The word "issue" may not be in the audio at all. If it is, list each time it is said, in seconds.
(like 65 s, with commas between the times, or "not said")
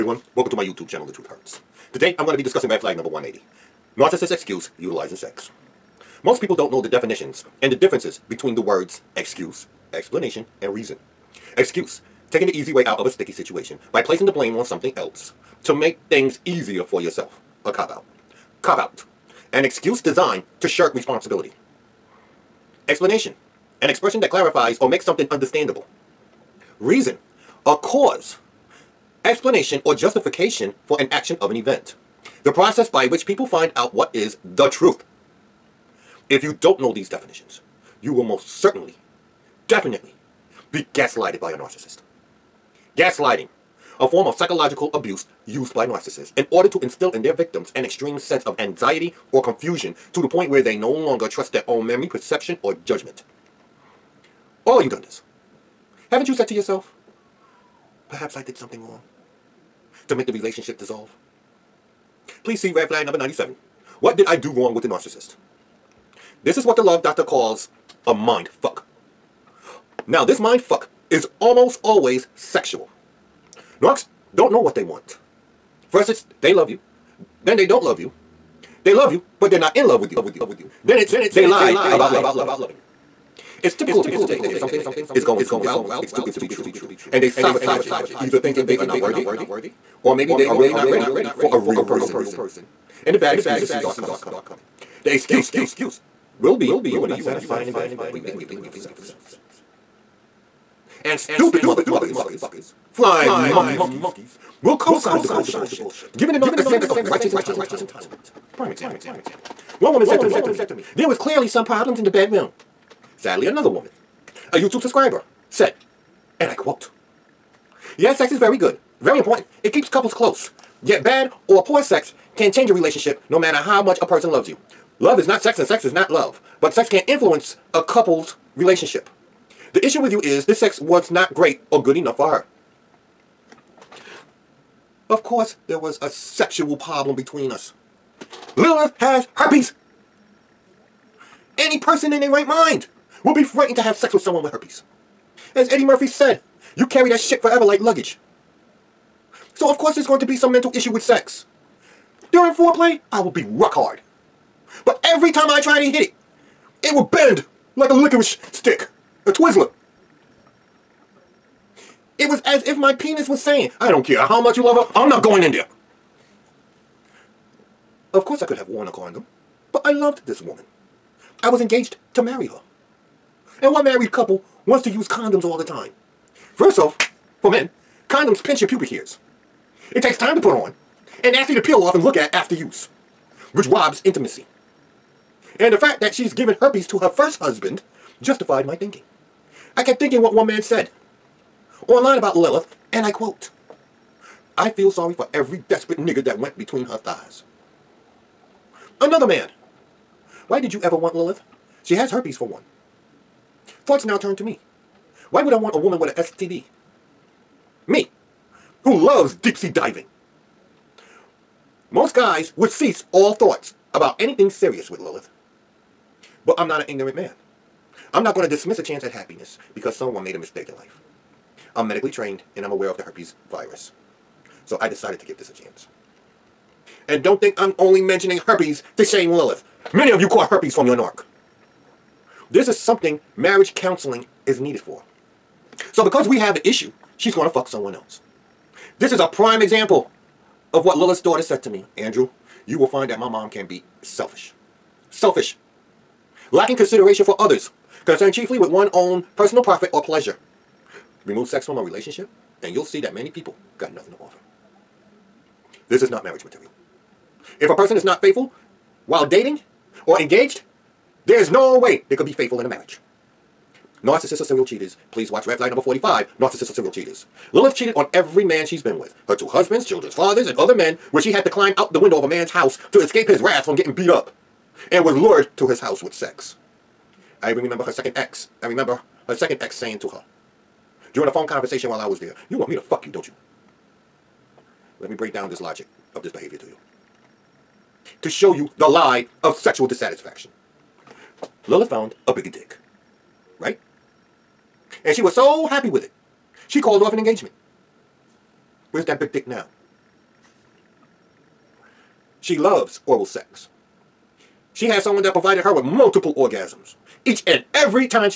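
129 s, 150 s, 236 s.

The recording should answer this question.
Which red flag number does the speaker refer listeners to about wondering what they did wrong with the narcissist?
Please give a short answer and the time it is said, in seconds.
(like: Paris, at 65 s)
97, at 63 s.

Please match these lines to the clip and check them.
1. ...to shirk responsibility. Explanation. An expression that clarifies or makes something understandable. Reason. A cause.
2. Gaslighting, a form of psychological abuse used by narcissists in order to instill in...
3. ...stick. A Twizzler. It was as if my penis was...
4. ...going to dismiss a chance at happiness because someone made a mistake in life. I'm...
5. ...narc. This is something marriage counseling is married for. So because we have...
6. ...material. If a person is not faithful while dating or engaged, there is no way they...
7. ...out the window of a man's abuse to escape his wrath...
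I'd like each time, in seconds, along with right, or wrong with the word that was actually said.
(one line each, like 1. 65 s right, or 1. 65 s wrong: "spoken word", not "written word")
1. 20 s right
2. 42 s right
3. 158 s right
4. 218 s right
5. 230 s wrong: "needed", not "married"
6. 256 s right
7. 271 s wrong: "house", not "abuse".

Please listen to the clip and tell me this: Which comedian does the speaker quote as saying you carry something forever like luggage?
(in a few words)
Eddie Murphy.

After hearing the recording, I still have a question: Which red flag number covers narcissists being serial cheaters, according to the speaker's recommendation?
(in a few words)
45.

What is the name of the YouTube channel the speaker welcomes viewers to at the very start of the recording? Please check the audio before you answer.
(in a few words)
The Truth Hurts.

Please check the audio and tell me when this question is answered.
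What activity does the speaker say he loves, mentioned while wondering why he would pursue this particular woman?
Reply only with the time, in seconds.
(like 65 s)
209 s.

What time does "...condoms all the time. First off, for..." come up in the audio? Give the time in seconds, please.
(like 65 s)
175 s.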